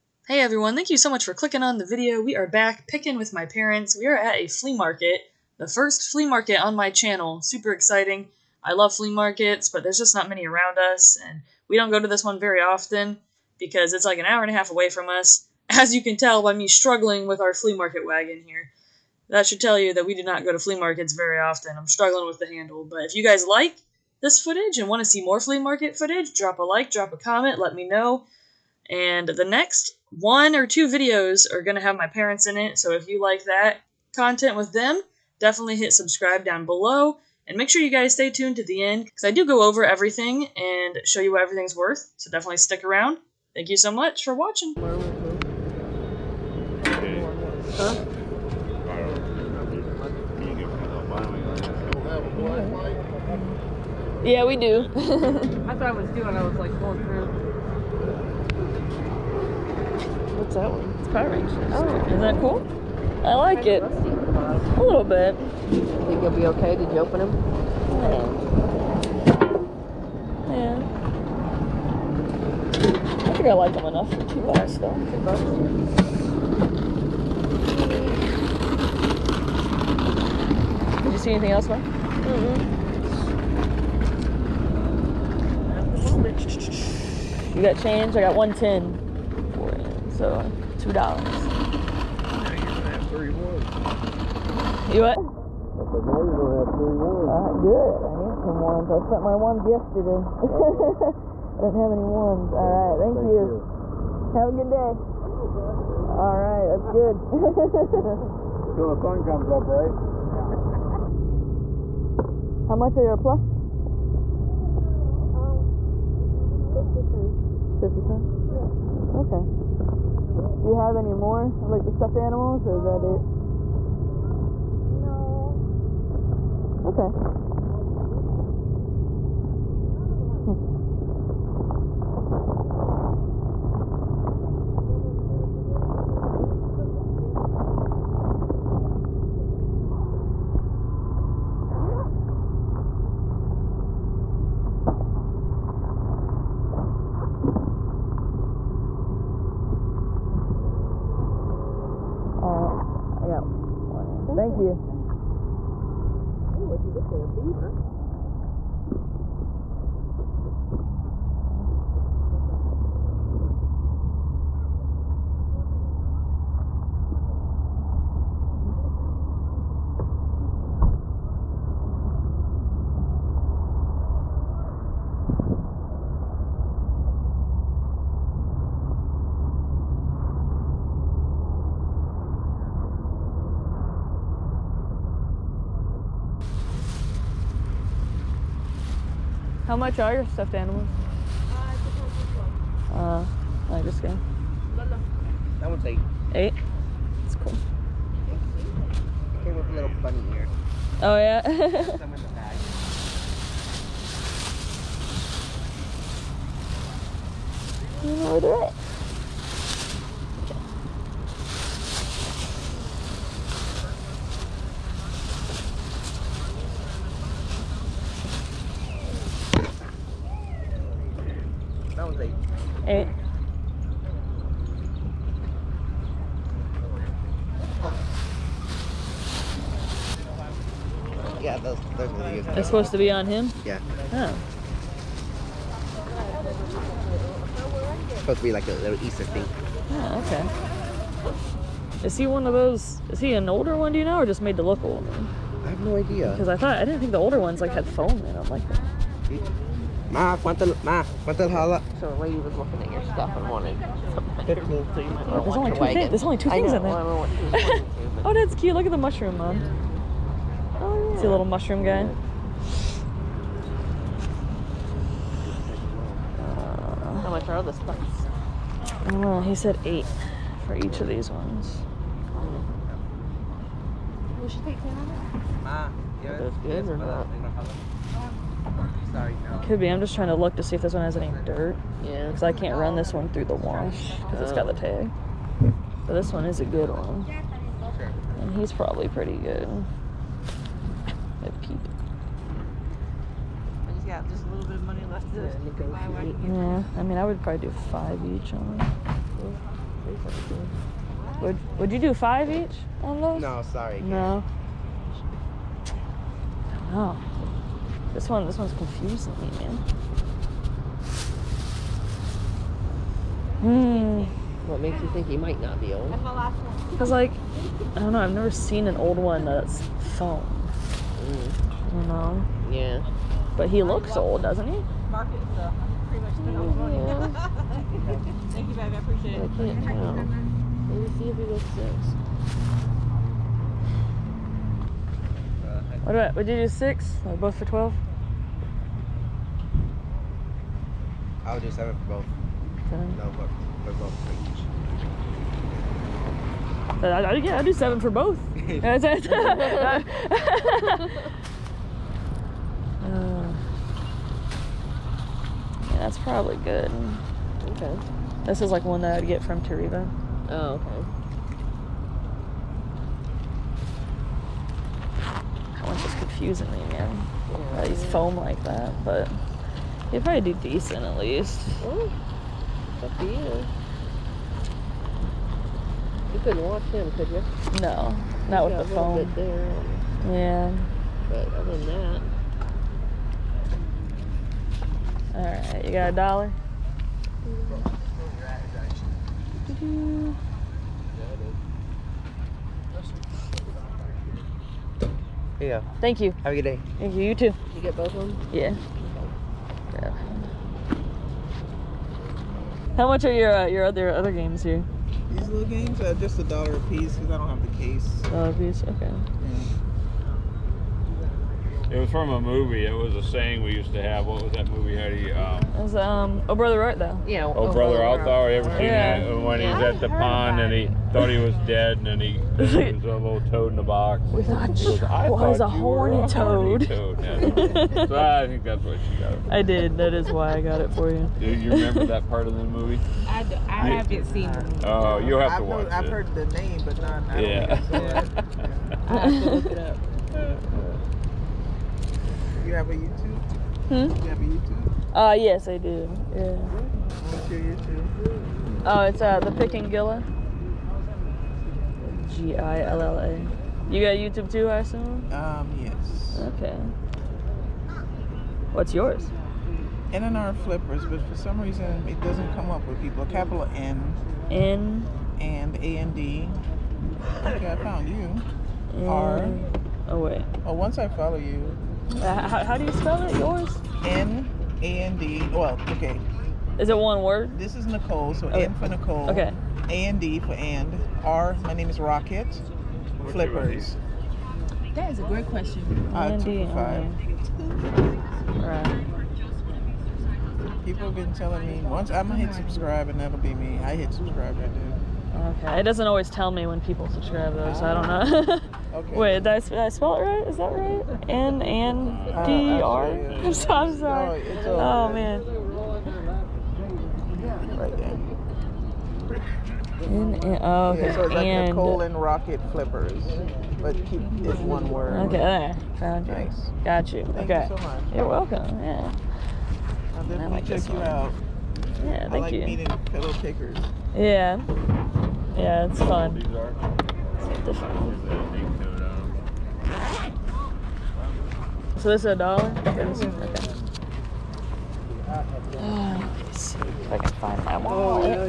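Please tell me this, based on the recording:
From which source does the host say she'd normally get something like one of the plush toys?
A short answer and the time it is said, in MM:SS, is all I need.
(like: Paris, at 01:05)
Toreba, at 05:59.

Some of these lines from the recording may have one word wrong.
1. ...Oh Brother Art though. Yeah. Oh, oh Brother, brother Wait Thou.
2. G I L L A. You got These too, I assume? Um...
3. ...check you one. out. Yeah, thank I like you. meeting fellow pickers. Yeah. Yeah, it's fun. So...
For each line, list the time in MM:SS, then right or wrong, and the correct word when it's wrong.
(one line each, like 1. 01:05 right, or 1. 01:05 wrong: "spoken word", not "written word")
1. 06:56 wrong: "Art", not "Wait"
2. 07:32 wrong: "YouTube", not "These"
3. 08:40 right.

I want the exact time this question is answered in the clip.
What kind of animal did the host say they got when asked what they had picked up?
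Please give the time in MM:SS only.
02:37.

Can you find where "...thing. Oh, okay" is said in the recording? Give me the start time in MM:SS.
03:59.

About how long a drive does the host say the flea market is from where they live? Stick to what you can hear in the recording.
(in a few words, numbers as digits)
an hour and a half.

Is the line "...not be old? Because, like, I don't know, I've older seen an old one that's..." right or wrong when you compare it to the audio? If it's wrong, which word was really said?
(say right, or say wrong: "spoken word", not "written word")
wrong: "never", not "older".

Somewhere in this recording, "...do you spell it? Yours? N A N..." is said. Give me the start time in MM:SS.
07:52.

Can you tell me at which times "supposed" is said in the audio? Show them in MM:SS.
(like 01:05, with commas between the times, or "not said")
03:52, 03:58.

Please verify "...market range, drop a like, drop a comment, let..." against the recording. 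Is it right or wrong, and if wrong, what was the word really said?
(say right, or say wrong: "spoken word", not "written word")
wrong: "footage", not "range".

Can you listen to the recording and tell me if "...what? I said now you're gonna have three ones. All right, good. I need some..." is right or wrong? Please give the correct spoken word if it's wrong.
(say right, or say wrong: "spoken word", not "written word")
right.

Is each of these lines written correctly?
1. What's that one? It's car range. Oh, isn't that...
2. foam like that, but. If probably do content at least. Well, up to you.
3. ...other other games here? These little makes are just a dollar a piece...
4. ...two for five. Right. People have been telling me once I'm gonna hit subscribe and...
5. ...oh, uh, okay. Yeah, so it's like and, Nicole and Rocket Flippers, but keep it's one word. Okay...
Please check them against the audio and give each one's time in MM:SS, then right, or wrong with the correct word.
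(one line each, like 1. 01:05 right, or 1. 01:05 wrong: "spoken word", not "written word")
1. 01:00 right
2. 06:08 wrong: "decent", not "content"
3. 06:43 wrong: "games", not "makes"
4. 08:06 right
5. 08:30 right.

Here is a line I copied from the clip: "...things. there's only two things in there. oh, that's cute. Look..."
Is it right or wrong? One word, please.
right.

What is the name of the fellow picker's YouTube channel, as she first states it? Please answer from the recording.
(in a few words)
NNR Flippers.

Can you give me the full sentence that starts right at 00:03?
We are at a flea market, the first flea market on my channel.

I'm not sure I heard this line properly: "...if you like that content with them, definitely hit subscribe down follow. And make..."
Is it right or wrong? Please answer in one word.
wrong.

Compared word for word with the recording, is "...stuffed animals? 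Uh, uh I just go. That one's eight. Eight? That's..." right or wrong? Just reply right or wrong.
right.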